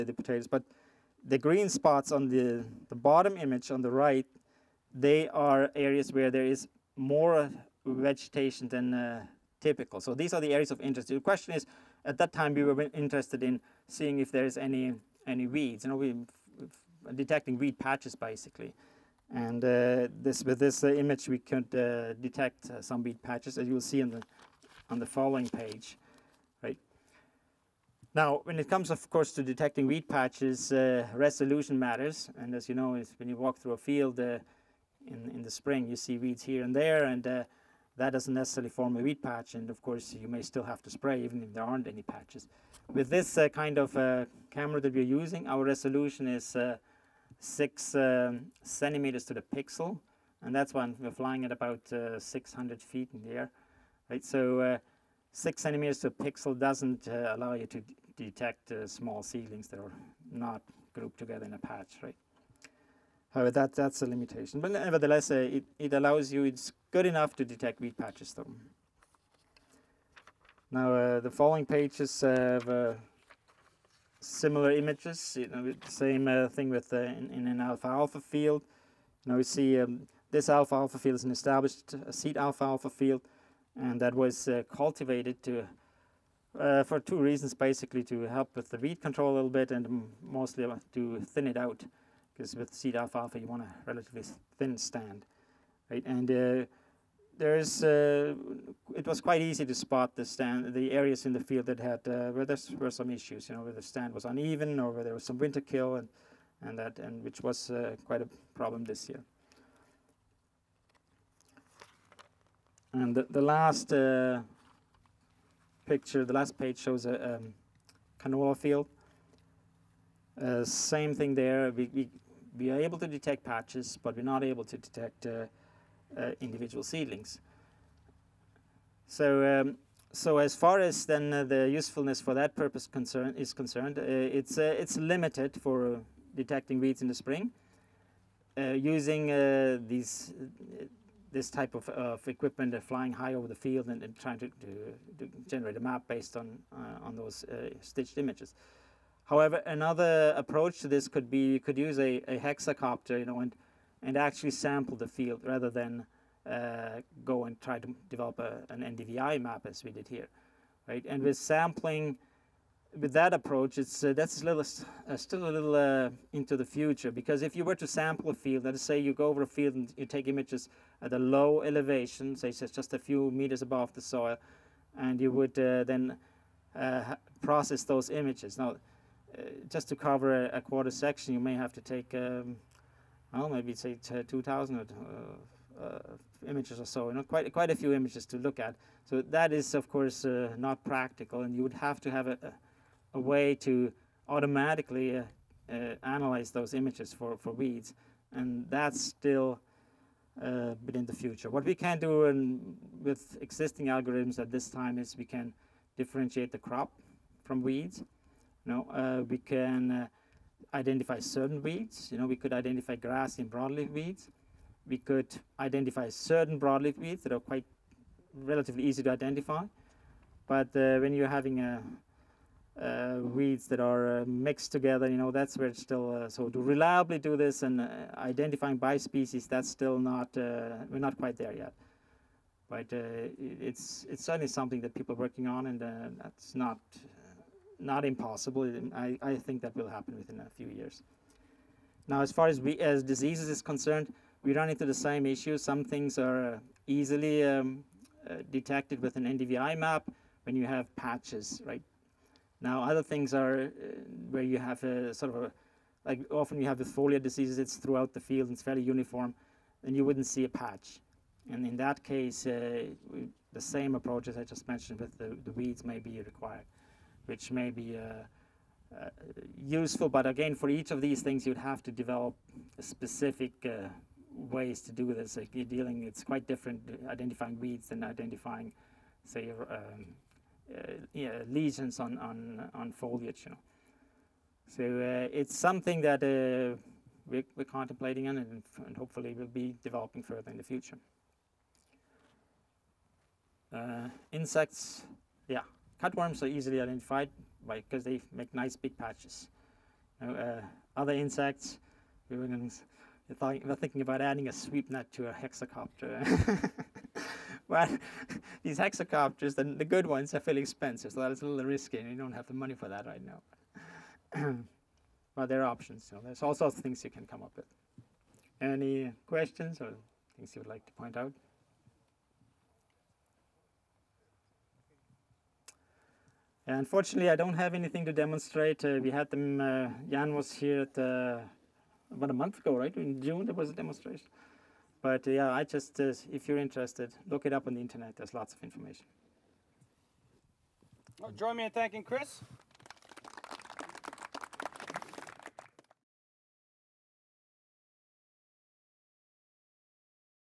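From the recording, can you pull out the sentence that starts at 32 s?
And as you know, when you walk through a field, in, in the spring.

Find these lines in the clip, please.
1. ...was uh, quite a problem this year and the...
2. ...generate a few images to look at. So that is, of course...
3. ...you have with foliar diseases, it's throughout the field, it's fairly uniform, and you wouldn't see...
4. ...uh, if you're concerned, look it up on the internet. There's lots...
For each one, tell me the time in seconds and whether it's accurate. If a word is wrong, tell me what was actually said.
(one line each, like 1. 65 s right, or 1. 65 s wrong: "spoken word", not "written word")
1. 107 s right
2. 187 s wrong: "quite", not "generate"
3. 256 s right
4. 336 s wrong: "interested", not "concerned".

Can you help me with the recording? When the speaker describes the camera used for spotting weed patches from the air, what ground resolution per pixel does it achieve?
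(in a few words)
6 centimeters.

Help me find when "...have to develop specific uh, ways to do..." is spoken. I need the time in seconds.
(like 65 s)
271 s.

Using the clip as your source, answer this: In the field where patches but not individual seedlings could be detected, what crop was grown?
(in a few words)
Canola.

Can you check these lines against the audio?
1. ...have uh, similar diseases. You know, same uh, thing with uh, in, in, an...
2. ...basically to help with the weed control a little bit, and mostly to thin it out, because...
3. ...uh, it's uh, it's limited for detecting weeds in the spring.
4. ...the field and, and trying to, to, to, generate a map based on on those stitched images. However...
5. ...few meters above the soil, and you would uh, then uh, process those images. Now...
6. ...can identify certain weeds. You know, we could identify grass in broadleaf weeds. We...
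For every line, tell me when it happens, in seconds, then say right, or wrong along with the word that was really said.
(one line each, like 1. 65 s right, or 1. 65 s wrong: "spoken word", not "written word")
1. 72 s wrong: "images", not "diseases"
2. 87 s right
3. 133 s right
4. 143 s right
5. 172 s right
6. 209 s right.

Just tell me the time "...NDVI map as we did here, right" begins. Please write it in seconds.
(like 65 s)
158 s.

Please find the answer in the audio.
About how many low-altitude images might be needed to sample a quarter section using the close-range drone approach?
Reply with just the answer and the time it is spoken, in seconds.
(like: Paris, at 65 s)
2,000, at 184 s.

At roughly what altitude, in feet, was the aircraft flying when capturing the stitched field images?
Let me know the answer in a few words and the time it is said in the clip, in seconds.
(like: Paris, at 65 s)
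600 feet, at 52 s.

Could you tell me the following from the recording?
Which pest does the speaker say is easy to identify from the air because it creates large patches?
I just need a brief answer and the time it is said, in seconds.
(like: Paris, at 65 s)
Cutworms, at 296 s.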